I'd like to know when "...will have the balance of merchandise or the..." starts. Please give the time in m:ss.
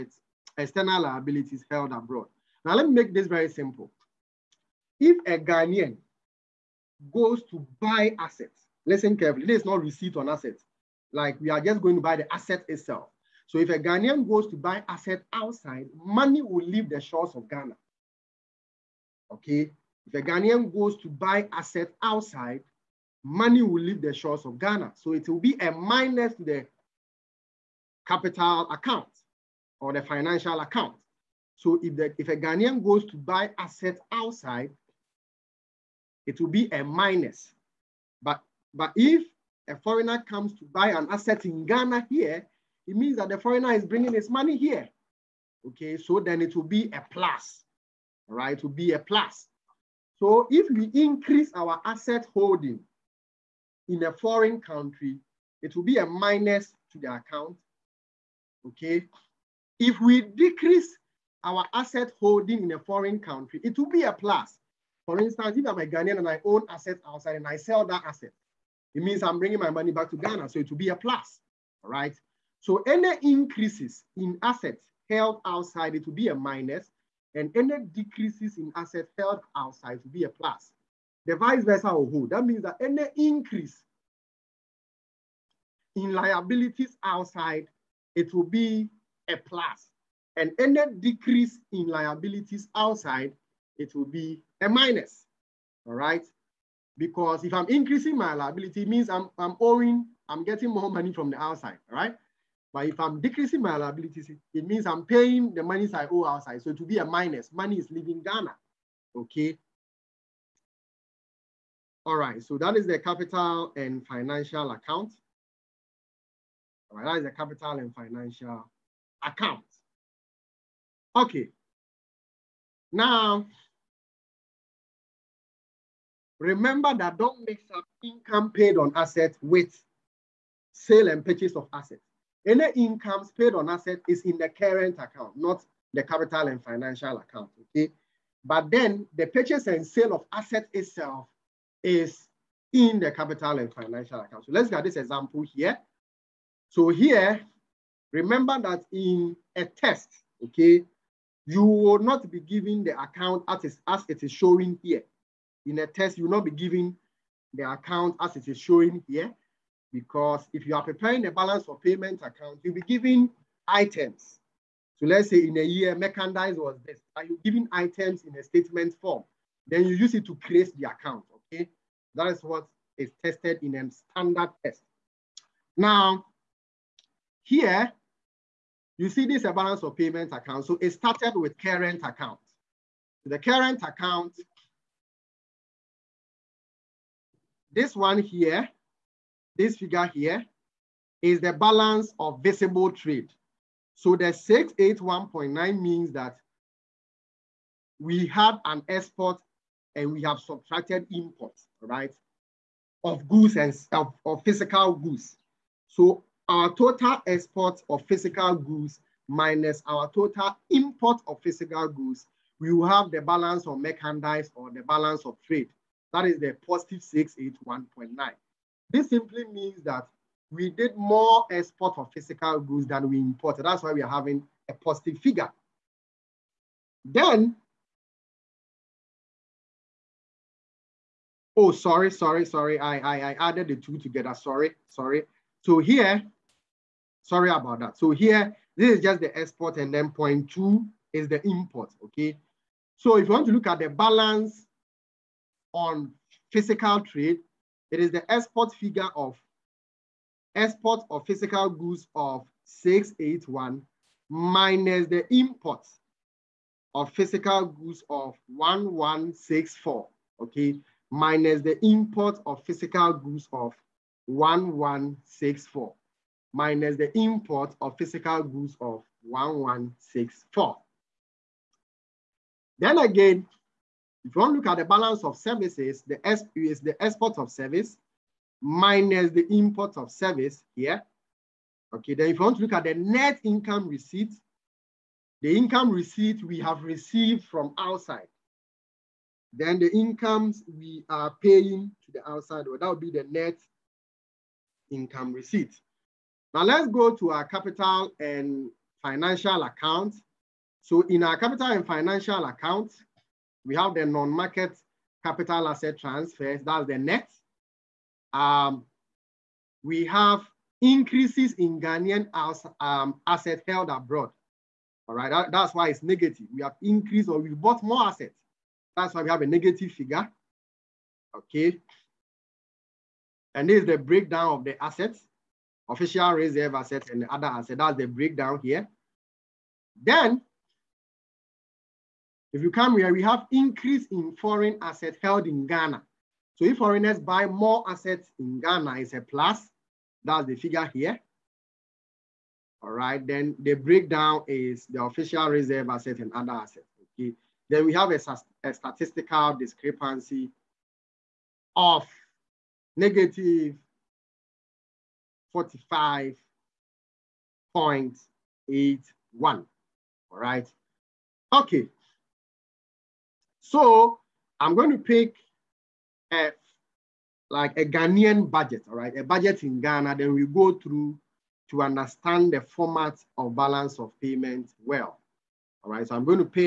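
3:32.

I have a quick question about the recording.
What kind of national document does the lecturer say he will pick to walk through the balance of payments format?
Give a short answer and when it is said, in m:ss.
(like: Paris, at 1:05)
A Ghanaian budget, at 6:07.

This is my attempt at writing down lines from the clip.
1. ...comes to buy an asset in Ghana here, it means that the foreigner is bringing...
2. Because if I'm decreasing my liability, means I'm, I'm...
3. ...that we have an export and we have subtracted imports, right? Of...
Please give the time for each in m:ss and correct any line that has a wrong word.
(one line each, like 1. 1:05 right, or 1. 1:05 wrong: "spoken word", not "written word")
1. 0:40 right
2. 1:36 wrong: "increasing", not "decreasing"
3. 3:16 right.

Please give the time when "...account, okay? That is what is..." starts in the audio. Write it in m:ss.
2:50.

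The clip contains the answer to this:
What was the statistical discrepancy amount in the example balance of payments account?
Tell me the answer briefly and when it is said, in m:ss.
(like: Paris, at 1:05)
-45.81, at 5:52.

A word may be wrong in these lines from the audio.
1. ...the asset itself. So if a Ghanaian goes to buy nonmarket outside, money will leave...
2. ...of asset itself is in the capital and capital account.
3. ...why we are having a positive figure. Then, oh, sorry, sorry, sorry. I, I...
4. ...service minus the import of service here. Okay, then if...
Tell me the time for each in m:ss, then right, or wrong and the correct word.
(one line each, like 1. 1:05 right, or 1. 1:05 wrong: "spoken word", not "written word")
1. 0:12 wrong: "asset", not "nonmarket"
2. 2:20 wrong: "financial", not "capital"
3. 3:43 right
4. 4:37 right.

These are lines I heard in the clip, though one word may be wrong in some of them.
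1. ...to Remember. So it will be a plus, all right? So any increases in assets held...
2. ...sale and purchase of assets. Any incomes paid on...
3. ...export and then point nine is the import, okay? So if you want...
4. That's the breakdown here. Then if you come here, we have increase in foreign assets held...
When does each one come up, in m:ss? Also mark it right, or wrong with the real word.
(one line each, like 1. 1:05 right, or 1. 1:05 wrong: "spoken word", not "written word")
1. 1:10 wrong: "Ghana", not "Remember"
2. 2:10 right
3. 3:59 wrong: "two", not "nine"
4. 5:27 right.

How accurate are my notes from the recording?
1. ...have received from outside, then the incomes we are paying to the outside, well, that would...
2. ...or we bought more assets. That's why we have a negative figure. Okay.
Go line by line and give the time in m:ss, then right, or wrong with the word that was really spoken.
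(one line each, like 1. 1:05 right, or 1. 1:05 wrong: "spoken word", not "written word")
1. 4:46 right
2. 5:17 right.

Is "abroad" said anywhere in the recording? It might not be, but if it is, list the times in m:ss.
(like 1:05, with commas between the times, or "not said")
0:01, 5:13.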